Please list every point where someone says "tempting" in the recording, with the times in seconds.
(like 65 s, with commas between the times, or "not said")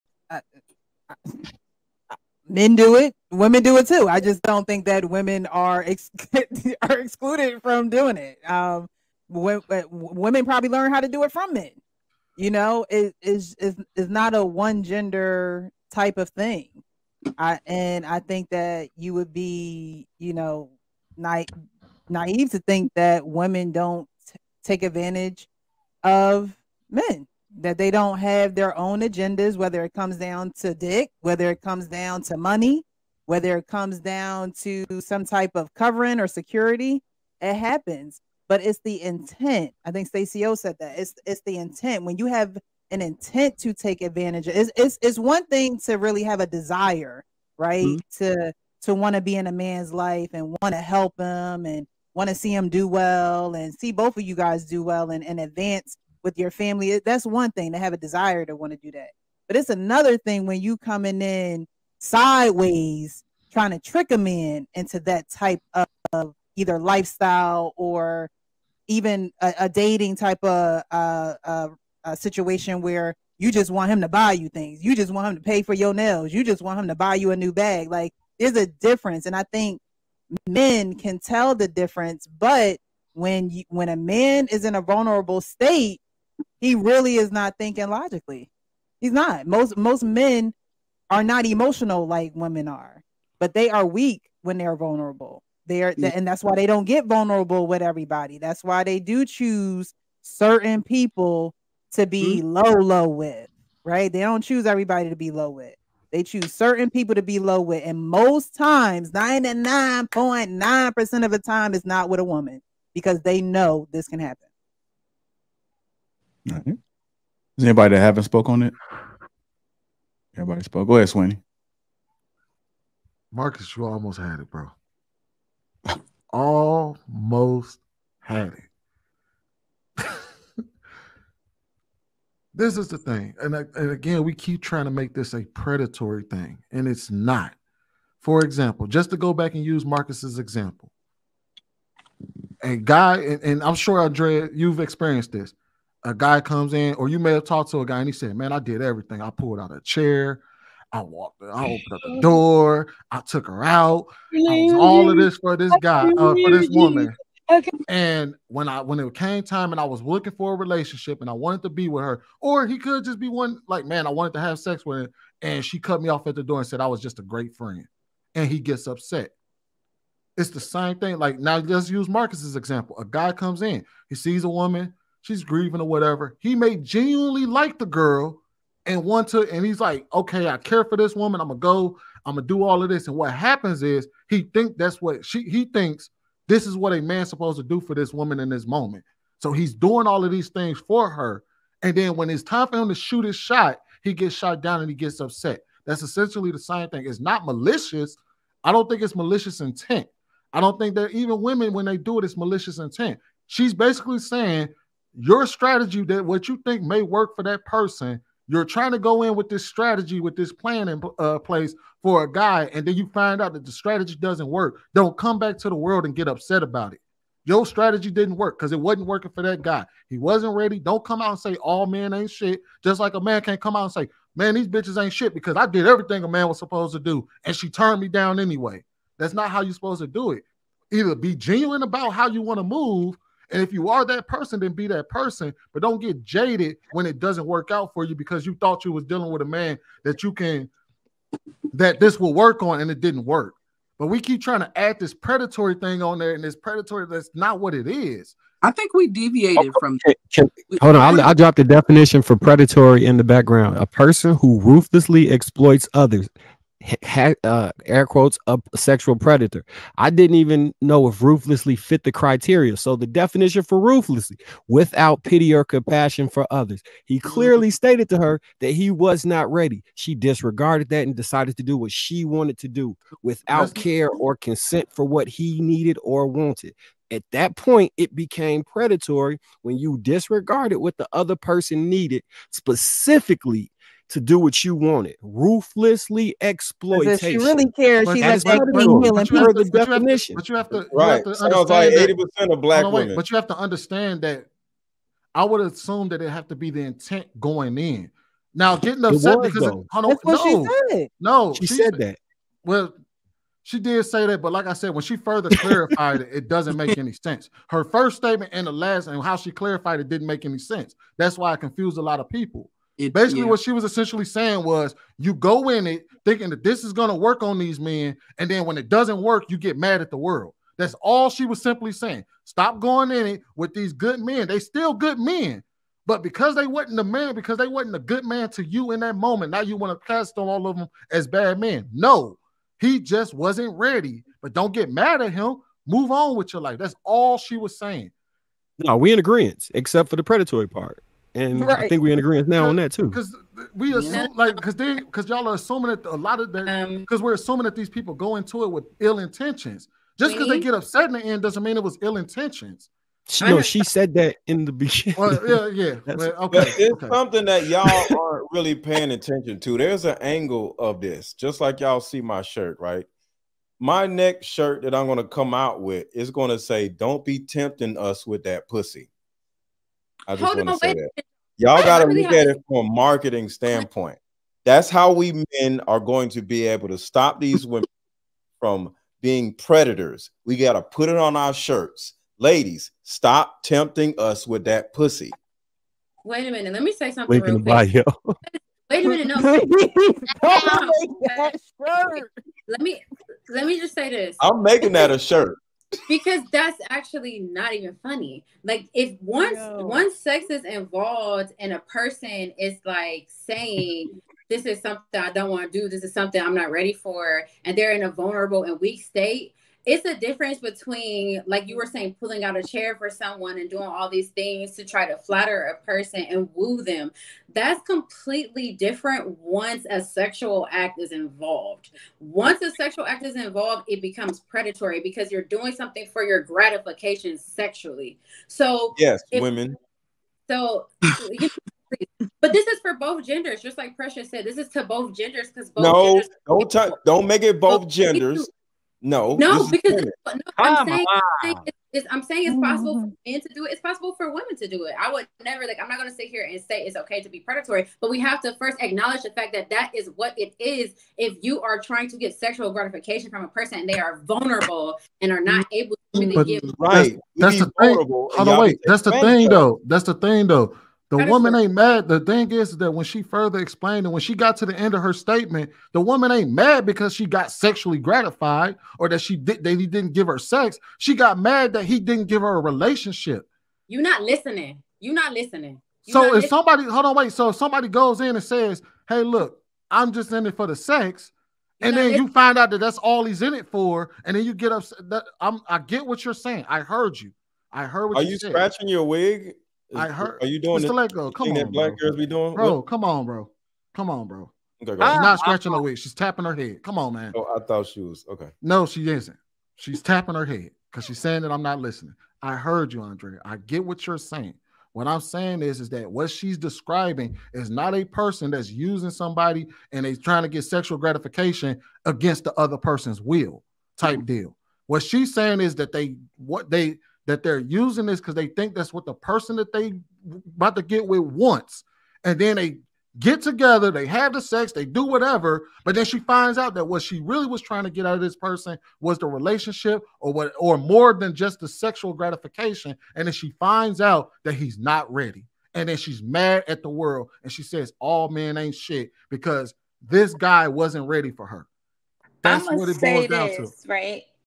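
367 s, 383 s.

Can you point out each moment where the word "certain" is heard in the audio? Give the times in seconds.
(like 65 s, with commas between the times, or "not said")
100 s, 106 s.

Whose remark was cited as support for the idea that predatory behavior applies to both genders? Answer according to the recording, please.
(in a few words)
Precious.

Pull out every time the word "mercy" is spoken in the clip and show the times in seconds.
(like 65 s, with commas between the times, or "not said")
not said.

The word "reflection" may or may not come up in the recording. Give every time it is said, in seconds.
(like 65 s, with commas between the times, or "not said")
not said.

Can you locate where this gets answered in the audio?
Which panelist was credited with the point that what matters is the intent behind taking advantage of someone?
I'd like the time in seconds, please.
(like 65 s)
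40 s.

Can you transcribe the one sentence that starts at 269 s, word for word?
She disregarded that and decided to do what she wanted to do without care or consent for what he needed or wanted.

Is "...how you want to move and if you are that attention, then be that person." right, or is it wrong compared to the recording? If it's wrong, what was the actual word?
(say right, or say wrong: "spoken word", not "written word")
wrong: "person", not "attention".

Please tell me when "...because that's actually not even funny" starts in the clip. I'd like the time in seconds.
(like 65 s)
396 s.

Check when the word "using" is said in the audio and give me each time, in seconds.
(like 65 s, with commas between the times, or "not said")
508 s, 517 s.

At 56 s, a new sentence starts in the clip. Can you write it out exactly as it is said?
That's one thing to have a desire to want to do that.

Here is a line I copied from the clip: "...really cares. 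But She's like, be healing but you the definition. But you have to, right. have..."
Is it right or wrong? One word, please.
right.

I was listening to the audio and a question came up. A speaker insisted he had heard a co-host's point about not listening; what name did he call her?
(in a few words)
Andre.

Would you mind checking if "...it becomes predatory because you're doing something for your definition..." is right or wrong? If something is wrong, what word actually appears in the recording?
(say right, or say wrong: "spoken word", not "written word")
wrong: "gratification", not "definition".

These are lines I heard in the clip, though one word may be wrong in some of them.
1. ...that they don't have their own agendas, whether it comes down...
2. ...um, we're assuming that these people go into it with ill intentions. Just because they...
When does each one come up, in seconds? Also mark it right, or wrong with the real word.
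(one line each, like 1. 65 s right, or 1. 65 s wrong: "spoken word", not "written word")
1. 27 s right
2. 347 s right.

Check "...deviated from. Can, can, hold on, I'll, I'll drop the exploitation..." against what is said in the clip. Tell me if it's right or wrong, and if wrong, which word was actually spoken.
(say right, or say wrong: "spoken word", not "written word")
wrong: "definition", not "exploitation".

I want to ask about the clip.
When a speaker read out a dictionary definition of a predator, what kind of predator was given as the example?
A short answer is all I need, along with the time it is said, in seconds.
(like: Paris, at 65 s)
A sexual predator, at 258 s.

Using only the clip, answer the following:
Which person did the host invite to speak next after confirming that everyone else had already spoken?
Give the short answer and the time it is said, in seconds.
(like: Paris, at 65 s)
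Swinney, at 121 s.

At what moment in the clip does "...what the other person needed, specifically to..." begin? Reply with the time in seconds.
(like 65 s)
280 s.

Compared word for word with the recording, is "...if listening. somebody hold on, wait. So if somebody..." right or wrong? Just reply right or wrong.
right.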